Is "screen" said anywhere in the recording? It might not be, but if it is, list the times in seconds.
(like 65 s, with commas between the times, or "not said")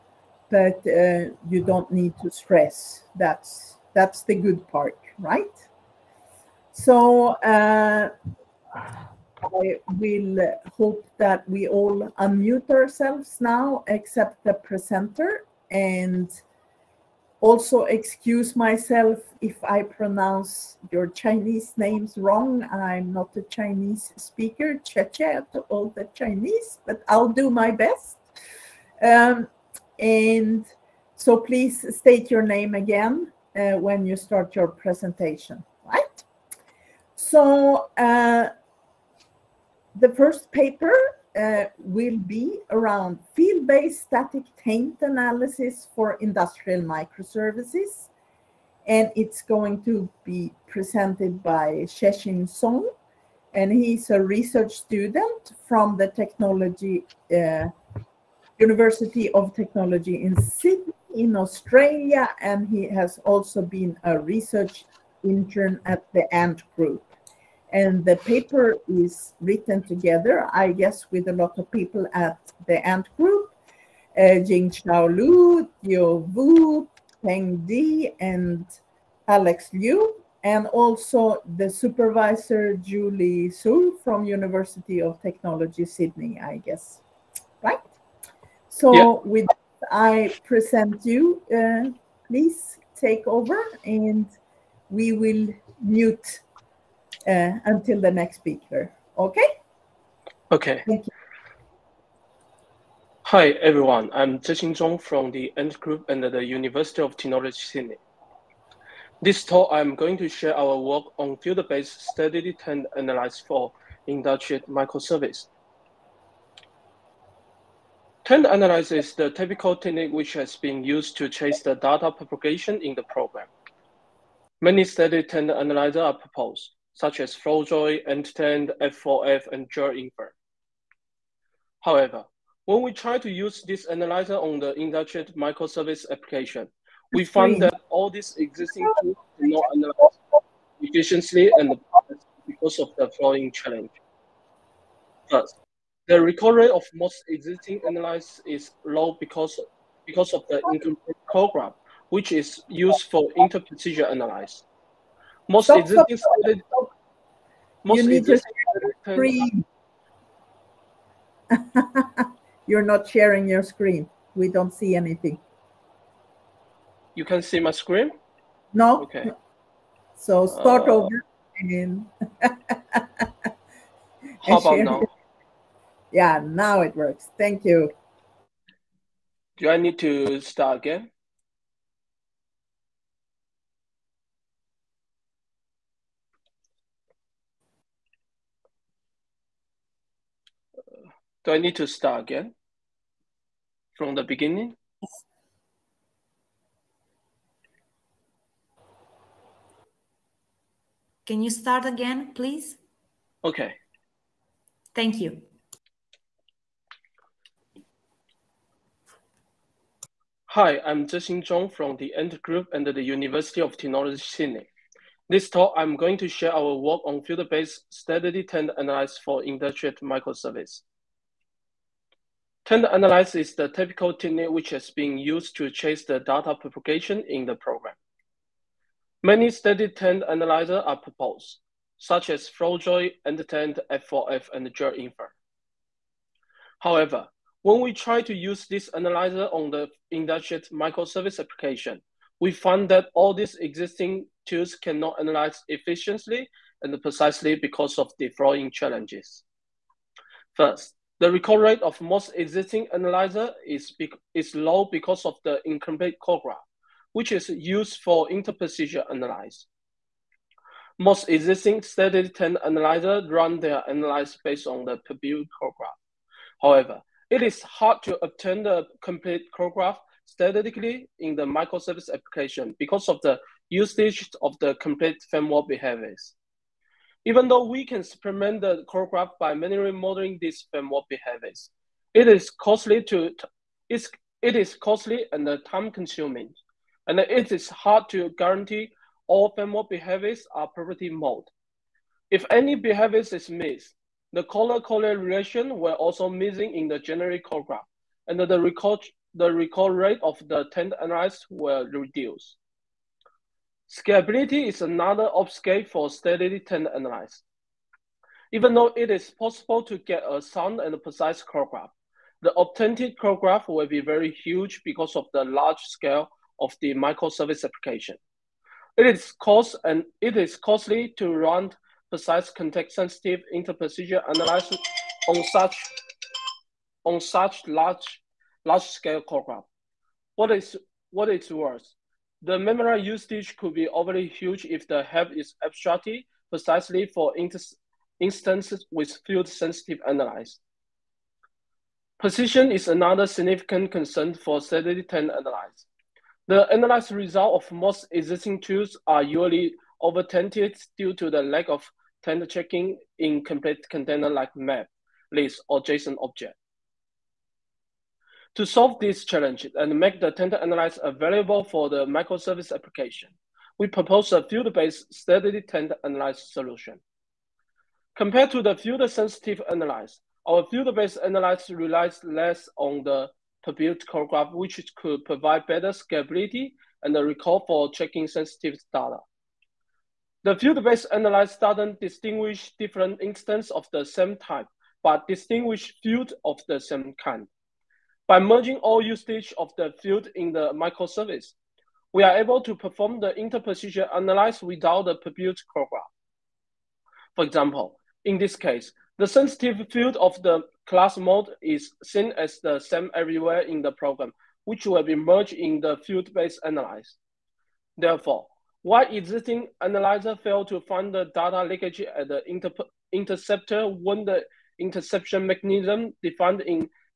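159 s, 163 s, 167 s.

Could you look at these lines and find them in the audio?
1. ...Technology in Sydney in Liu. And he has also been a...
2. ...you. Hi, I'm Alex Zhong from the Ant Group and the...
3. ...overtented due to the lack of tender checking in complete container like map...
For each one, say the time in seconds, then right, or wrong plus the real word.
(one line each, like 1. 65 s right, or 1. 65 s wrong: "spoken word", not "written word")
1. 59 s wrong: "Australia", not "Liu"
2. 205 s wrong: "Zexin", not "Alex"
3. 350 s right.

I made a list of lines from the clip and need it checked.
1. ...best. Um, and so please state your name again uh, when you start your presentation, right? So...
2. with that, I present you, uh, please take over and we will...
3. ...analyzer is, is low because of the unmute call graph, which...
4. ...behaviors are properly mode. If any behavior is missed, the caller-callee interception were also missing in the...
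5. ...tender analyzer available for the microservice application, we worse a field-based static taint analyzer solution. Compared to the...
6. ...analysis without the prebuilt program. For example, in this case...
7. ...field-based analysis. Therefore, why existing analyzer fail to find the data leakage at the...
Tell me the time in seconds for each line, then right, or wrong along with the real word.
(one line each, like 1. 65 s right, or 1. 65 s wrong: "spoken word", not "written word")
1. 27 s right
2. 89 s right
3. 252 s wrong: "incomplete", not "unmute"
4. 289 s wrong: "relation", not "interception"
5. 360 s wrong: "propose", not "worse"
6. 394 s right
7. 406 s right.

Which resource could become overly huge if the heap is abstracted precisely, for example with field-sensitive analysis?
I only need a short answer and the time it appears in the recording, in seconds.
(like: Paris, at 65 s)
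Memory usage, at 332 s.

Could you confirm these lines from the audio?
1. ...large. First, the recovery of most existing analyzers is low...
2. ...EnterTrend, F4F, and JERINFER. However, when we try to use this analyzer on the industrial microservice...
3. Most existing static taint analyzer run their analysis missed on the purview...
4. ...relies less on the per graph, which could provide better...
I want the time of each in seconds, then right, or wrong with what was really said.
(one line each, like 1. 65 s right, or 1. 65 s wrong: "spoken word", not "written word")
1. 143 s wrong: "challenge", not "large"
2. 233 s right
3. 260 s wrong: "based", not "missed"
4. 371 s right.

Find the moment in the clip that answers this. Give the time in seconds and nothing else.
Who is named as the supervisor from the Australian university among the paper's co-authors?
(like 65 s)
82 s.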